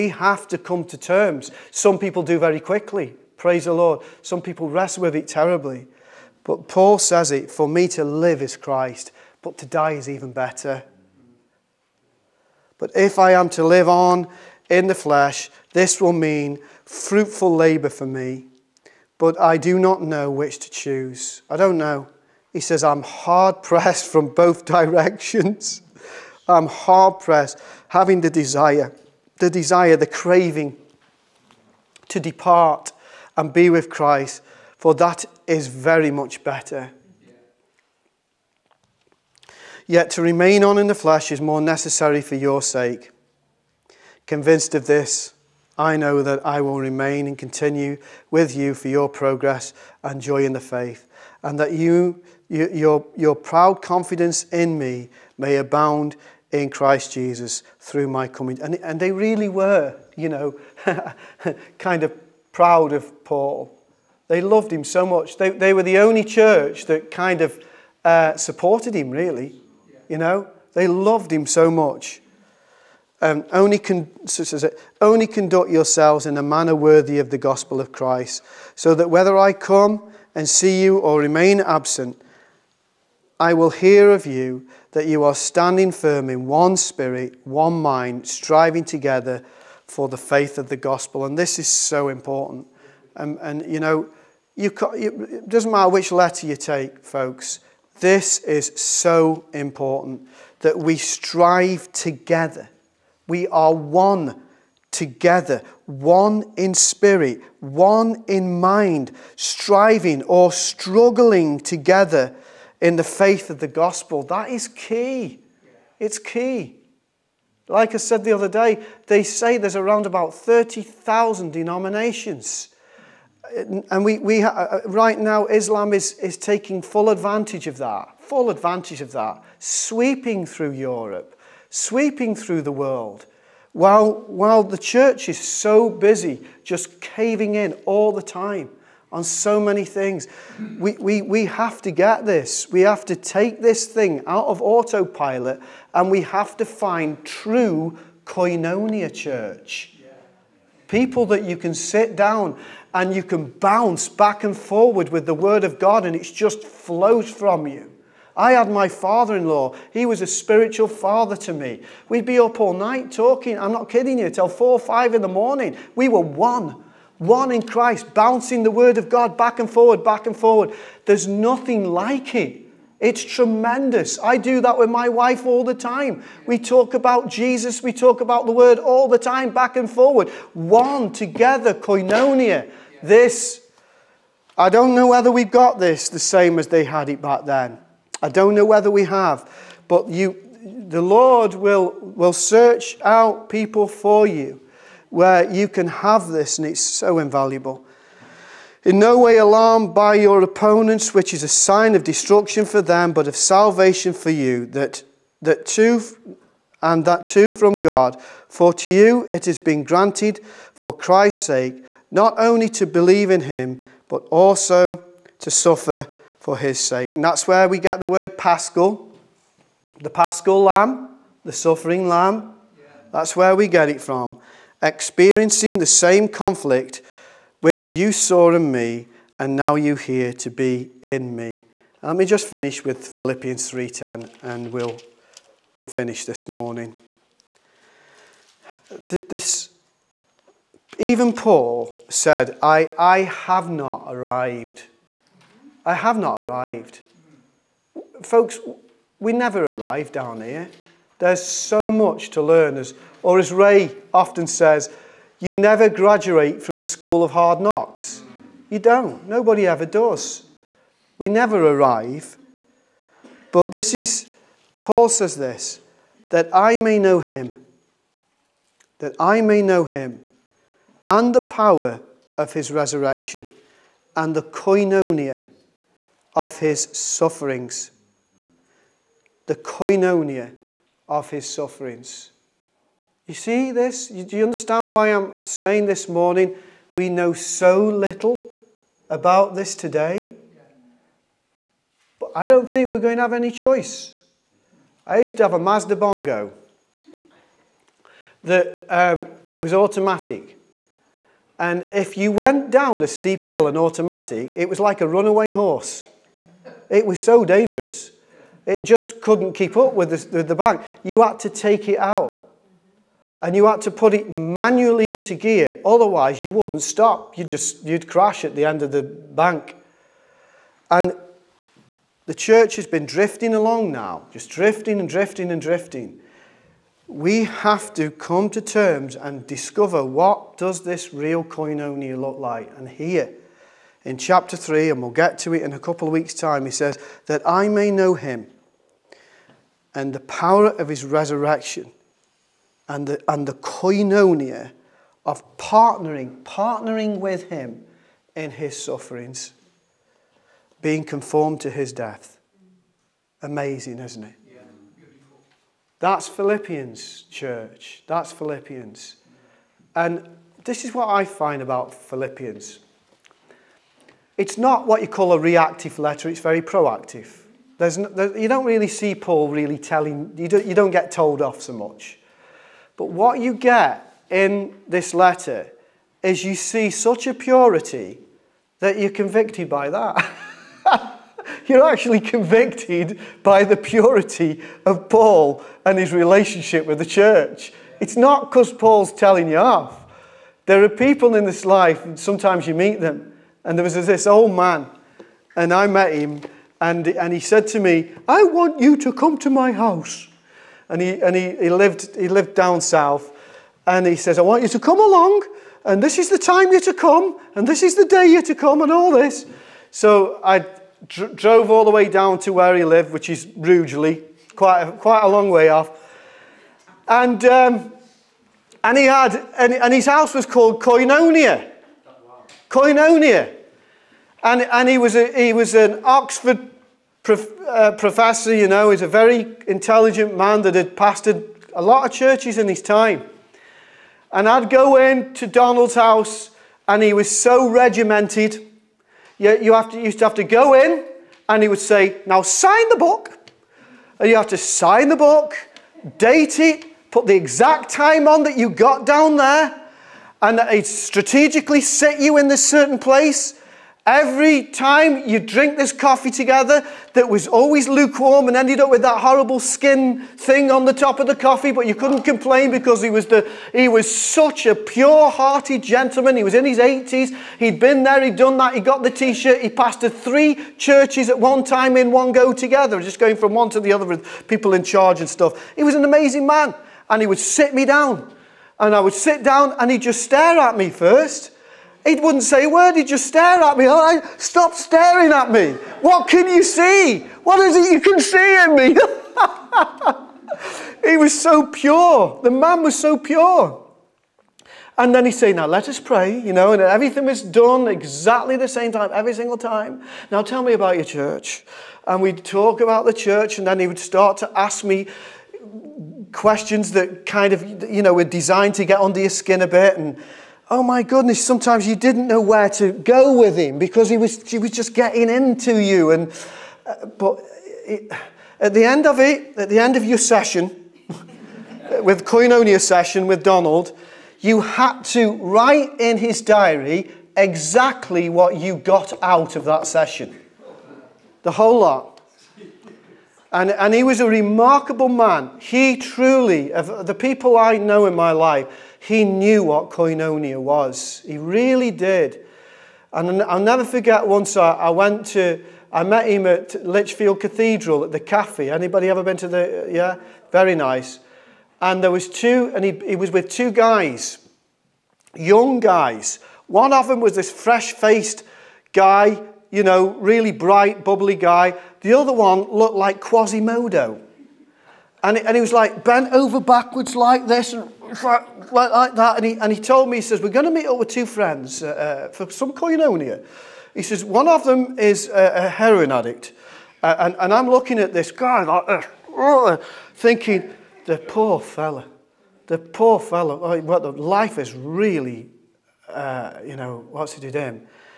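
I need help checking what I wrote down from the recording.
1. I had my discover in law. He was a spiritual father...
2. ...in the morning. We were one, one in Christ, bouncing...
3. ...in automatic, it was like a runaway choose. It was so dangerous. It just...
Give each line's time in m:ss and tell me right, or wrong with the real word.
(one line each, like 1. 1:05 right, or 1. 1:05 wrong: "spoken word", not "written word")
1. 2:38 wrong: "father", not "discover"
2. 2:45 right
3. 5:03 wrong: "horse", not "choose".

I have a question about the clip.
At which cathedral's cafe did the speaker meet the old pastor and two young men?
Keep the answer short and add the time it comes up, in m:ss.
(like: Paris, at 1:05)
Lichfield Cathedral, at 9:06.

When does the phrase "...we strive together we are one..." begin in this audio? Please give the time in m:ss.
1:40.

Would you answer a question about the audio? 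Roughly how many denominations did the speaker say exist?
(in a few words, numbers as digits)
30,000.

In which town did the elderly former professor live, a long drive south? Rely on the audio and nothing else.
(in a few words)
Rugeley.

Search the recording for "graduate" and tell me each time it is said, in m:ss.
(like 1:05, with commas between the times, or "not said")
4:15.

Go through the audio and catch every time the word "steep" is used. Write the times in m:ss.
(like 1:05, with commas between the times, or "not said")
5:03.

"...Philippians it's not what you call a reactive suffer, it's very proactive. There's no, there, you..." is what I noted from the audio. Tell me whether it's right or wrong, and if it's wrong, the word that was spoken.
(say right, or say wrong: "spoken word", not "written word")
wrong: "letter", not "suffer".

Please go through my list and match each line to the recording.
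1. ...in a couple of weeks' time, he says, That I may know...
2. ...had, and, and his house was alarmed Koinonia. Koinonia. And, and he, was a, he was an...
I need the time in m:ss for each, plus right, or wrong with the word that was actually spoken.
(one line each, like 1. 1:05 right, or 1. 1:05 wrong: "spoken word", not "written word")
1. 5:35 right
2. 6:59 wrong: "called", not "alarmed".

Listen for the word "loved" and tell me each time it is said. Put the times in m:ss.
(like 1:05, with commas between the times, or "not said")
1:04, 1:10.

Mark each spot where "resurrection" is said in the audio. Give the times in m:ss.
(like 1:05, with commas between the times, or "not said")
4:32, 5:41.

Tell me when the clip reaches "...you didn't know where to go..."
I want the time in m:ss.
8:31.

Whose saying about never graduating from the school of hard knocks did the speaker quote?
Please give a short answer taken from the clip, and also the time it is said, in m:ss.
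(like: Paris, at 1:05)
Ray, at 4:13.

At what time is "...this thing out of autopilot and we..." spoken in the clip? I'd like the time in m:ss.
2:23.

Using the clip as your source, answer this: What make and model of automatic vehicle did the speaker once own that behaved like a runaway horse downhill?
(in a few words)
Mazda Bongo.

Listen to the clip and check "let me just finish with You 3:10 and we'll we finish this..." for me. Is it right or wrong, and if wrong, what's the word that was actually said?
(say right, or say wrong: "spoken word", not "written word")
wrong: "Philippians", not "You".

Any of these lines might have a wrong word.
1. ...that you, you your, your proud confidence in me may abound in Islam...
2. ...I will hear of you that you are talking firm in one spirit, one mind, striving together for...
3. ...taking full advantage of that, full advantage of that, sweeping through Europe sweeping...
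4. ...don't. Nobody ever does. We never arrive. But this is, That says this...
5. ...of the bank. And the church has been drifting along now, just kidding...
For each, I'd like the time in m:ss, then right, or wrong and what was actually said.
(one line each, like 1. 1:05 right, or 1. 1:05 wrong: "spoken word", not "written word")
1. 0:51 wrong: "Christ", not "Islam"
2. 1:23 wrong: "standing", not "talking"
3. 2:06 right
4. 4:18 wrong: "Paul", not "That"
5. 5:18 wrong: "drifting", not "kidding".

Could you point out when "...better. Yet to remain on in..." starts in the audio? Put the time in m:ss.
0:36.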